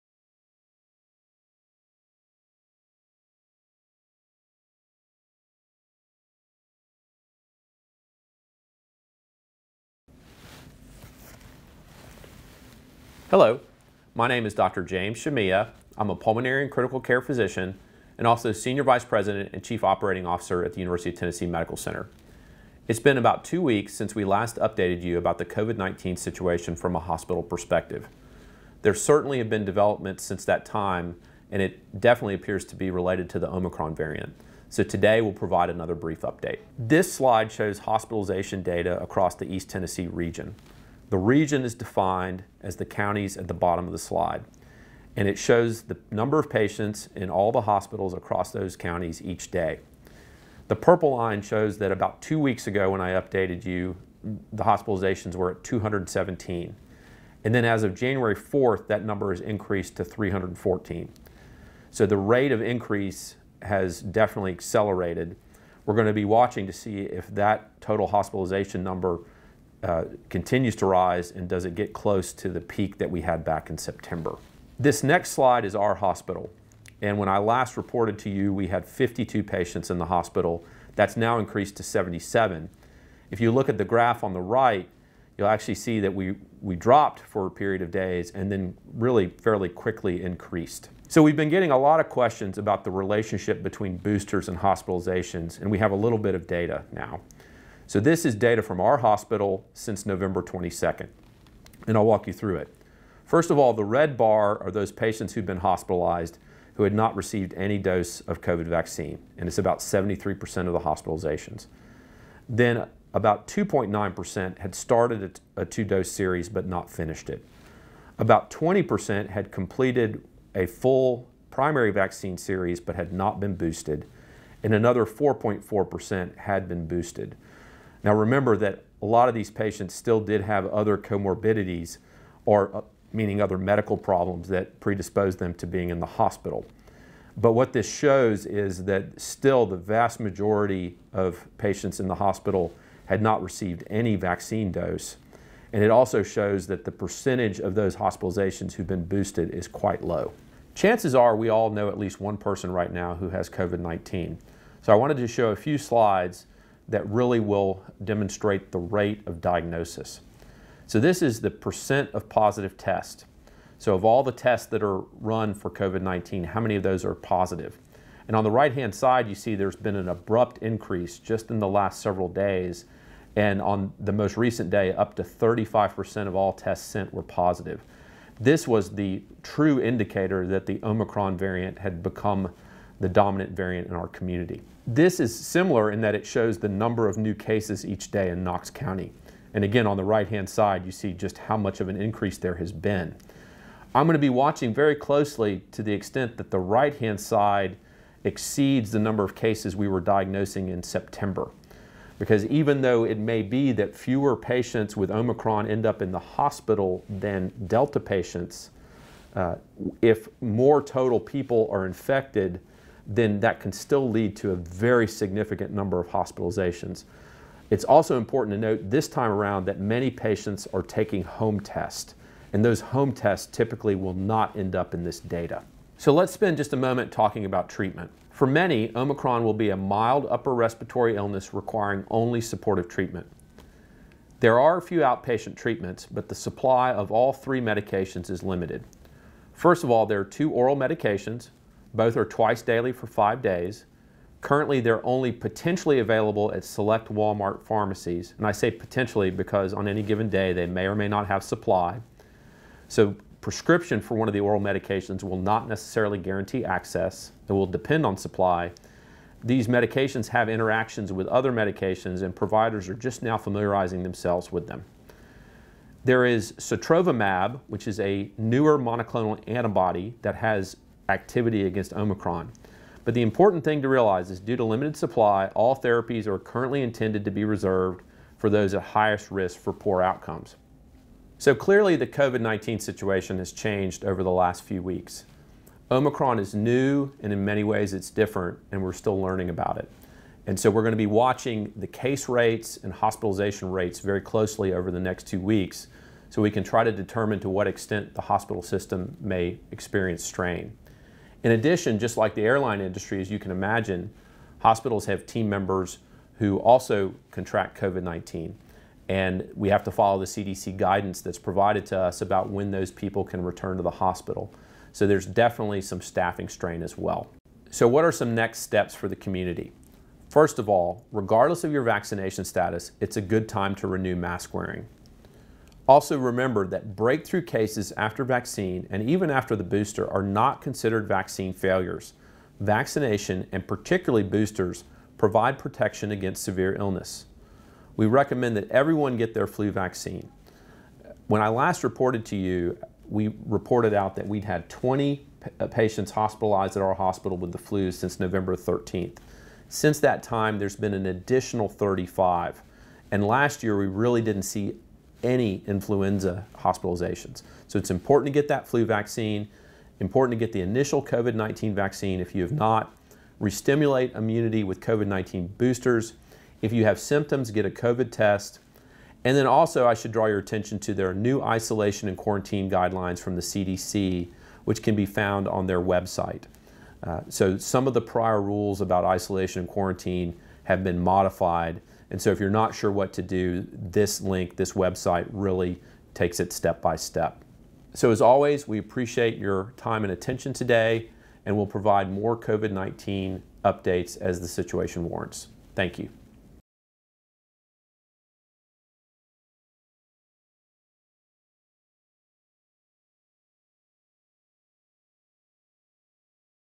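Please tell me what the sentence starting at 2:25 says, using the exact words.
And it also shows that the percentage of those hospitalizations who've been boosted is quite low.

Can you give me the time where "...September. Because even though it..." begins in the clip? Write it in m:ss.
3:20.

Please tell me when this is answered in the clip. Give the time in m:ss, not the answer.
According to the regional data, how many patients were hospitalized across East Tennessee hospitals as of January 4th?
1:00.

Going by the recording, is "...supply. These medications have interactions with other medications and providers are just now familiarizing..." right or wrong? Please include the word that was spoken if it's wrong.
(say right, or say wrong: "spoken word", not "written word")
right.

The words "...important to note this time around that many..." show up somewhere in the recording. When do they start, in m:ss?
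3:38.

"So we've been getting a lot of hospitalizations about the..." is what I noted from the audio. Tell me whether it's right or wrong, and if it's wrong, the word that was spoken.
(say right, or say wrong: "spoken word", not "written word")
wrong: "questions", not "hospitalizations".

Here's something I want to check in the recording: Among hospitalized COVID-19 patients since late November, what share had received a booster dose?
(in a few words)
4.4%.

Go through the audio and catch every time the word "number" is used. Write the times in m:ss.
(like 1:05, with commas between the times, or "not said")
0:46, 0:59, 1:08, 3:06, 3:18, 3:35.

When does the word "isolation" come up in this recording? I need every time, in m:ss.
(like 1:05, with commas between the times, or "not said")
6:11, 6:19.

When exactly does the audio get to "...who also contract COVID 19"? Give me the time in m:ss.
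5:06.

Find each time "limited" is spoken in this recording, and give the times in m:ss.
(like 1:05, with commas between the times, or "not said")
3:58, 4:34.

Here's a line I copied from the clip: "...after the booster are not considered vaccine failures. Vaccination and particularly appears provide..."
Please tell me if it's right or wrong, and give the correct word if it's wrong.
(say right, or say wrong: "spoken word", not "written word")
wrong: "boosters", not "appears".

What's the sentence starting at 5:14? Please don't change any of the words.
So there's definitely some staffing strain as well.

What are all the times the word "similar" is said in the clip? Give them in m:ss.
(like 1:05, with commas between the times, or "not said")
3:05.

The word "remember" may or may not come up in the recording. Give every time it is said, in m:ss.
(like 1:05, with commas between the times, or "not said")
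2:08, 5:26.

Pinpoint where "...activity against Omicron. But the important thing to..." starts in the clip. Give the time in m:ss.
4:31.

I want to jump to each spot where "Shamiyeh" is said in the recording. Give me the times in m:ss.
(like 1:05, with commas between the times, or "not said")
0:15.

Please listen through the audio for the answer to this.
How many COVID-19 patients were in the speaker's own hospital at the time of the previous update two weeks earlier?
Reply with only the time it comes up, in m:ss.
1:18.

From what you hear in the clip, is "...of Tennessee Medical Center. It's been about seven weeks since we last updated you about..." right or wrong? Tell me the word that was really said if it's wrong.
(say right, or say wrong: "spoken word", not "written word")
wrong: "two", not "seven".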